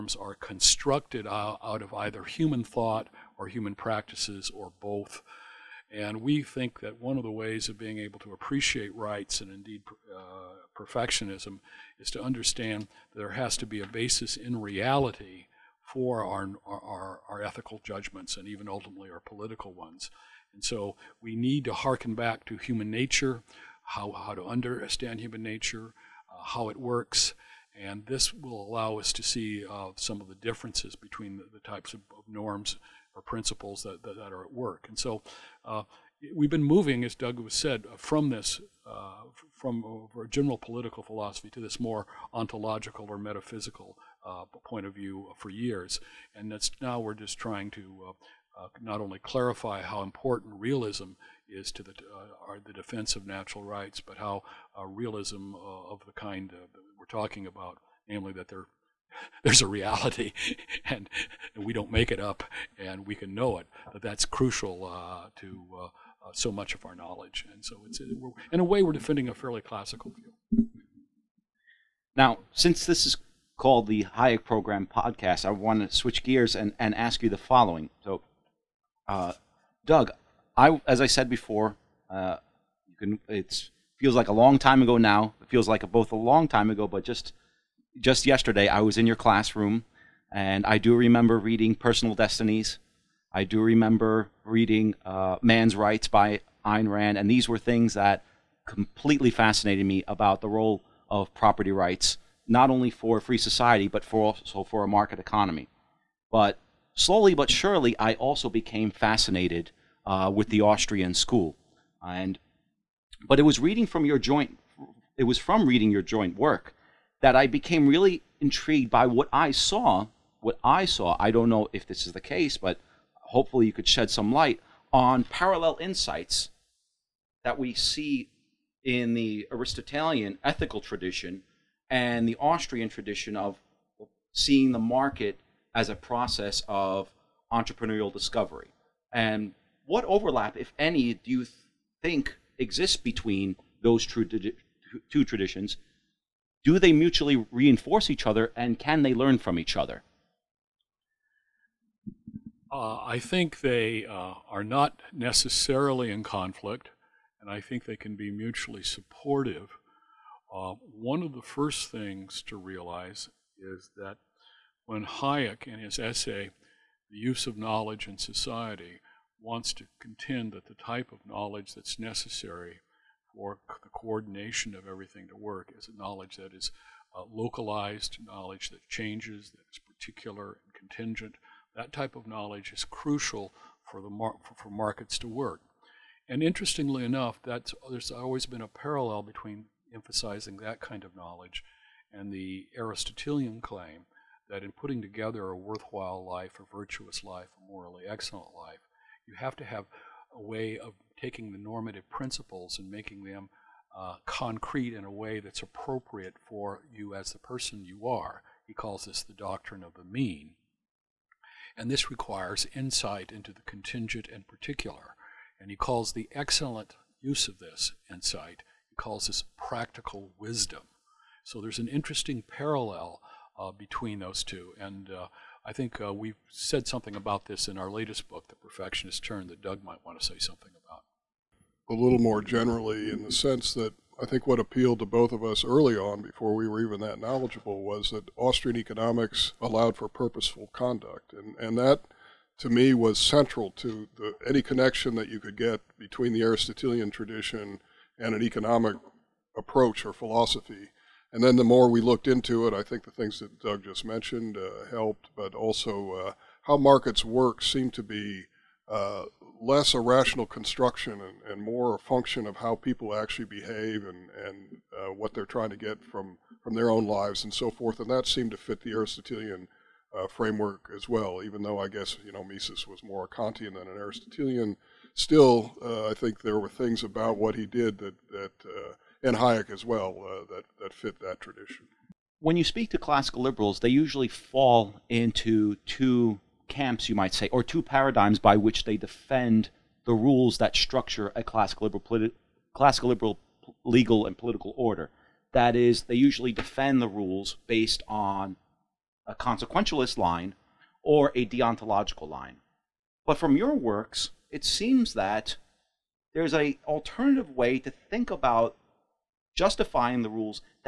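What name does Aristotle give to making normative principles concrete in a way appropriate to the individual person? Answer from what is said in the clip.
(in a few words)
doctrine of the mean.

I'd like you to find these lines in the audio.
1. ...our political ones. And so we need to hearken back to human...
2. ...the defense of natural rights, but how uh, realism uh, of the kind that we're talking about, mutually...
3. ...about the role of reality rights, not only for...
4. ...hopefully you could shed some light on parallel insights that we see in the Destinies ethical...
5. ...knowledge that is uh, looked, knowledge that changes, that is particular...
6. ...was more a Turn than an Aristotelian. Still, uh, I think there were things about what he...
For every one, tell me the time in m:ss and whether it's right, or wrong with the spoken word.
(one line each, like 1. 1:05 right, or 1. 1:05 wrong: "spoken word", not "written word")
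1. 0:19 right
2. 0:52 wrong: "namely", not "mutually"
3. 1:40 wrong: "property", not "reality"
4. 2:03 wrong: "Aristotelian", not "Destinies"
5. 2:56 wrong: "localized", not "looked"
6. 4:32 wrong: "Kantian", not "Turn".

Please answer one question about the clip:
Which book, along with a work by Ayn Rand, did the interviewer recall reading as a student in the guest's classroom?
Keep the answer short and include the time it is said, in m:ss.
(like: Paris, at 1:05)
Personal Destinies, at 1:31.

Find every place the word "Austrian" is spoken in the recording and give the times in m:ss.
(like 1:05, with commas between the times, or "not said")
1:50, 2:12, 3:58.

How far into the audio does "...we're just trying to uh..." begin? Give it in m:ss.
0:46.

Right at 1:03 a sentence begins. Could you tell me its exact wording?
that that's crucial to so much of our knowledge, and so it's in a way we're defending a fairly classical view.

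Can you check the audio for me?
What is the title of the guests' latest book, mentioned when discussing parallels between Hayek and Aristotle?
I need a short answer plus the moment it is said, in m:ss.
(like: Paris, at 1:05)
The Perfectionist Turn, at 3:48.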